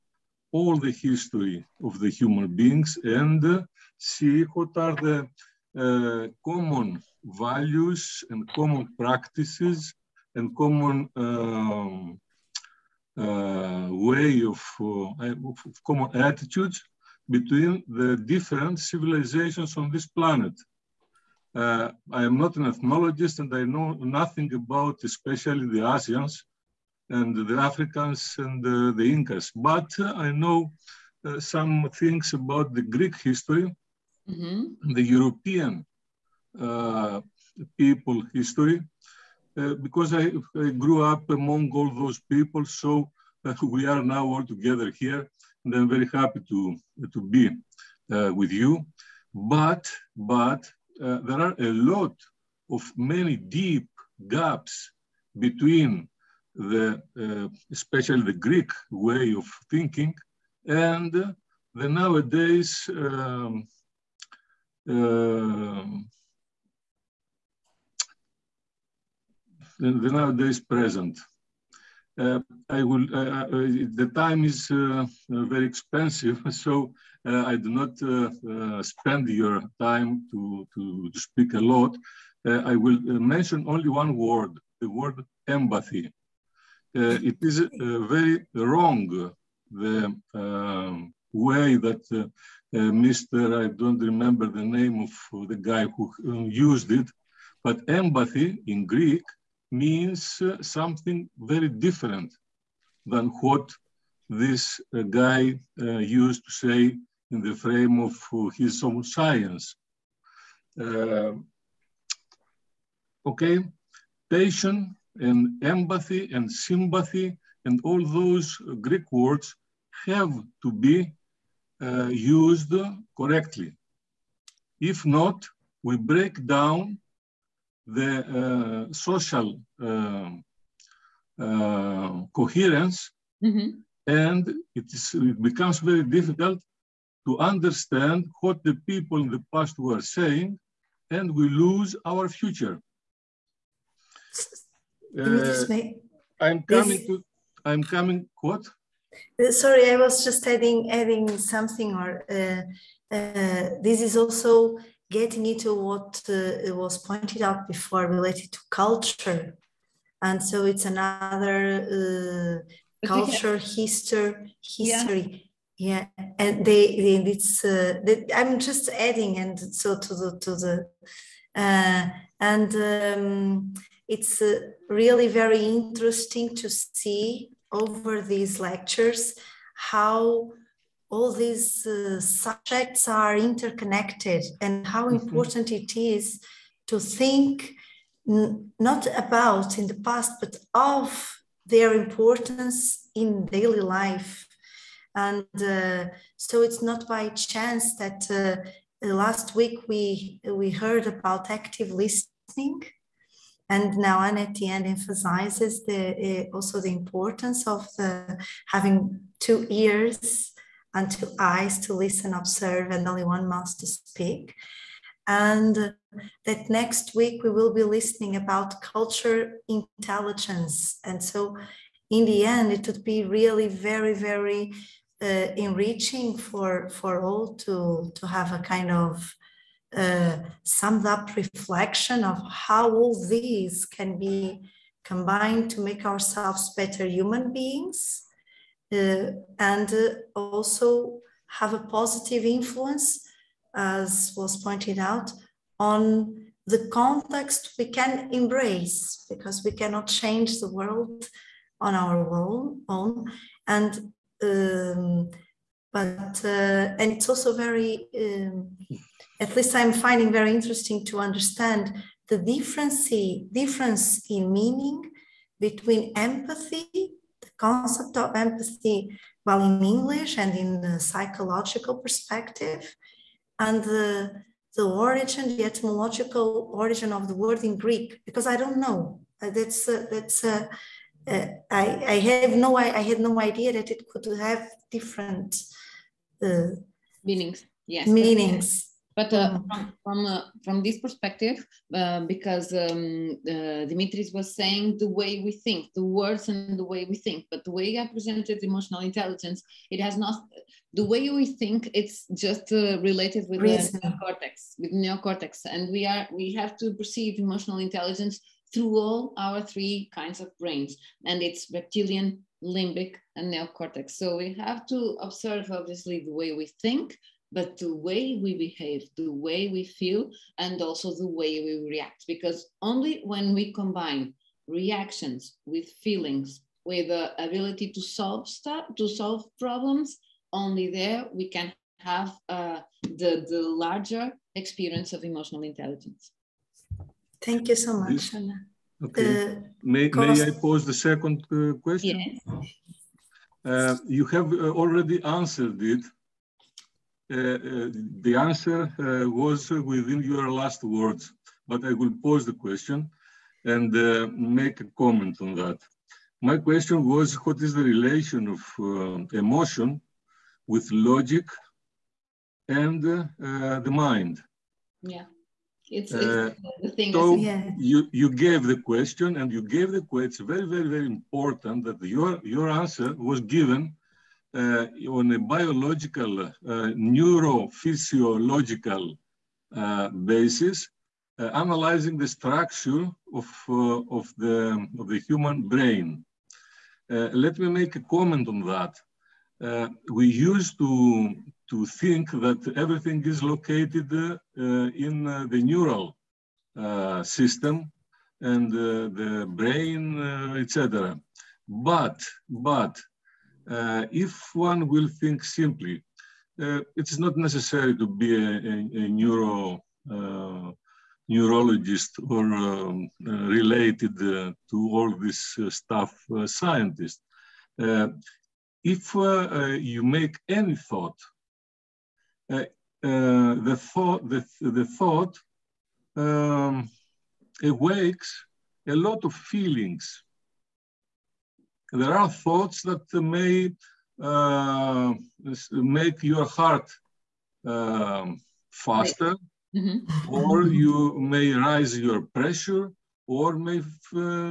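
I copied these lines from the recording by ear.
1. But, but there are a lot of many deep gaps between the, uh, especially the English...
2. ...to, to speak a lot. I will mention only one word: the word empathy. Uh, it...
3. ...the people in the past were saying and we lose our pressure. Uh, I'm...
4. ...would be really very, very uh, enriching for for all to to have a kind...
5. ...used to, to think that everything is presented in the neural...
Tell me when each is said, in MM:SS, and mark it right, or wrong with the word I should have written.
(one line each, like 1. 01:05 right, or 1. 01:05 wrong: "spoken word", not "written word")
1. 00:49 wrong: "Greek", not "English"
2. 01:20 right
3. 02:18 wrong: "future", not "pressure"
4. 03:42 right
5. 06:30 wrong: "located", not "presented".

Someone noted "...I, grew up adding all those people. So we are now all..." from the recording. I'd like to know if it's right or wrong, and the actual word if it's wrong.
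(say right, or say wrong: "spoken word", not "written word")
wrong: "among", not "adding".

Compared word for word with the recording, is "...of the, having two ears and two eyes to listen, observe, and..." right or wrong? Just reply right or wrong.
right.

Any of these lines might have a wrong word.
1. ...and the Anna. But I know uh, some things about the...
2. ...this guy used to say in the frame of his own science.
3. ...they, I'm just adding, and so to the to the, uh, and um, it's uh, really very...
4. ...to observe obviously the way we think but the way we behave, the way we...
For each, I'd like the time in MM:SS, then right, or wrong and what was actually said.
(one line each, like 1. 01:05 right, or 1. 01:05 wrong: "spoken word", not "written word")
1. 00:28 wrong: "Incas", not "Anna"
2. 01:44 right
3. 02:48 right
4. 05:14 right.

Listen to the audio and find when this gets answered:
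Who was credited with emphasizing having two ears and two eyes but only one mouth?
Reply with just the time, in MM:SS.
03:23.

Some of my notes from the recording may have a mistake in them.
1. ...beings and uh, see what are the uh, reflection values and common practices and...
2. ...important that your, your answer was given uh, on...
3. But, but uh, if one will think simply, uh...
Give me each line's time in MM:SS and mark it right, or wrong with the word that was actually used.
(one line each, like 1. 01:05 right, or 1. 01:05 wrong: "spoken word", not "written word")
1. 00:02 wrong: "common", not "reflection"
2. 06:11 right
3. 06:41 right.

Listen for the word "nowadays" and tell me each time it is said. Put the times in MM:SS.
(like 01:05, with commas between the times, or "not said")
01:01, 01:10.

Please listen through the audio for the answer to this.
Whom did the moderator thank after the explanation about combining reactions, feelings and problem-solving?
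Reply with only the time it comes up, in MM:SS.
05:38.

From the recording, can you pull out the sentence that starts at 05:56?
My question was, what is the relation of emotion with logic and the mind?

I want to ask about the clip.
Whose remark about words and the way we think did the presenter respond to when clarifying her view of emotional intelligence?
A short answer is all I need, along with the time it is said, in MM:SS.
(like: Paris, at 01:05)
Dimitris, at 04:53.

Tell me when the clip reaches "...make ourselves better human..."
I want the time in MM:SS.
03:55.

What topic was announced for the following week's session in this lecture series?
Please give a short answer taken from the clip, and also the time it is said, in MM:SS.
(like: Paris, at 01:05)
culture intelligence, at 03:38.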